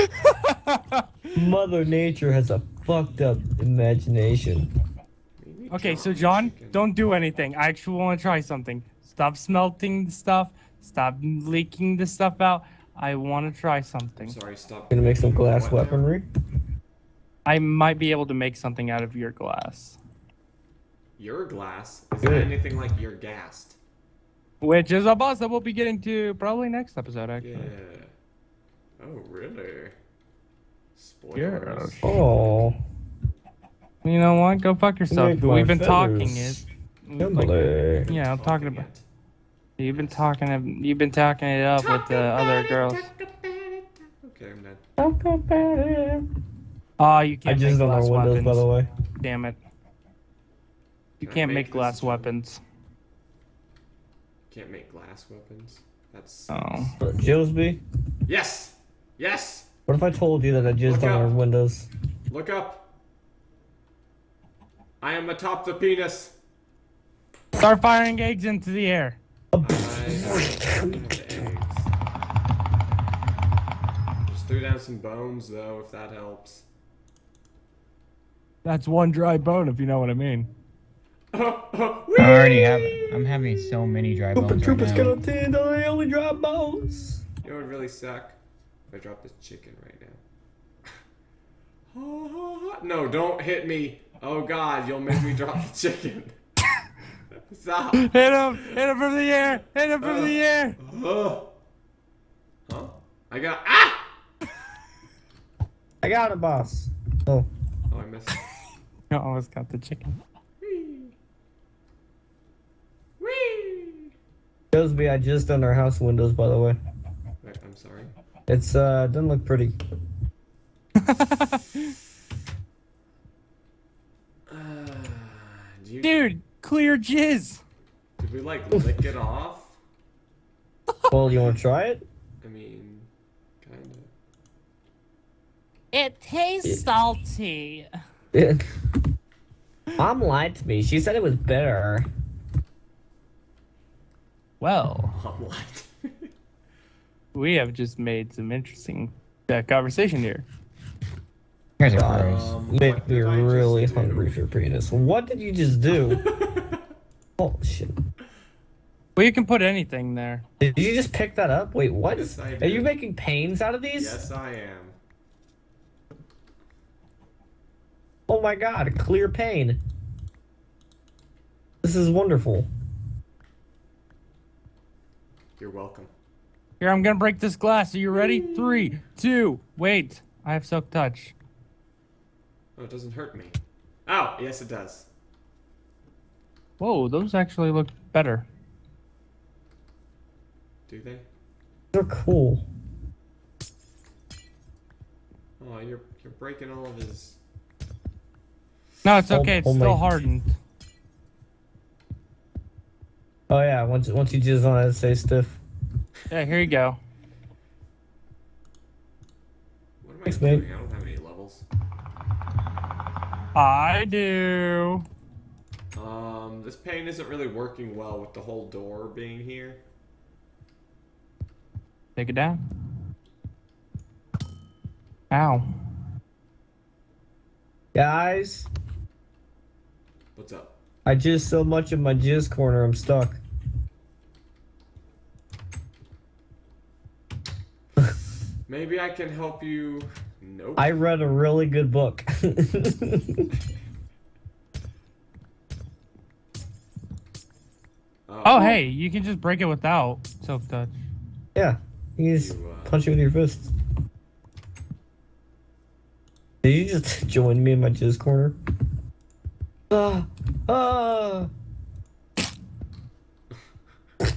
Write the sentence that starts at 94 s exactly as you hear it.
Oh God, you'll make me drop the chicken.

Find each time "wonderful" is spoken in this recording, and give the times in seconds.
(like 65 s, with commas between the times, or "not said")
172 s.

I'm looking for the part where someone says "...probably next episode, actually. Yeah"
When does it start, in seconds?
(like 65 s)
26 s.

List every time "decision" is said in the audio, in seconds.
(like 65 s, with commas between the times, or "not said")
not said.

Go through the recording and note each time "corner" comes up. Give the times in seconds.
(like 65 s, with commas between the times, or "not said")
232 s, 258 s.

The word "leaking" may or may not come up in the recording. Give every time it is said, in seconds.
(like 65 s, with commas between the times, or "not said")
11 s.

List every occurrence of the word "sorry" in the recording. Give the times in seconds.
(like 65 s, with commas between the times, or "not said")
14 s, 117 s.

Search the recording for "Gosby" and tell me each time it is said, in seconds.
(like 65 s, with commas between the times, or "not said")
114 s.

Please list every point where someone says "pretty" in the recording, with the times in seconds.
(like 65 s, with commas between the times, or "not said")
119 s.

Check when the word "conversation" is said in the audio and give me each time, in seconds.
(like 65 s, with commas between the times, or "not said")
149 s.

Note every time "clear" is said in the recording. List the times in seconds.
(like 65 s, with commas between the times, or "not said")
126 s, 168 s.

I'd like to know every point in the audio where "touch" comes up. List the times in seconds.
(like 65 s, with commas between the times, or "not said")
180 s, 250 s.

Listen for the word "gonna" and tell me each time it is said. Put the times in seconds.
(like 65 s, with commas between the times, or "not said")
14 s, 177 s.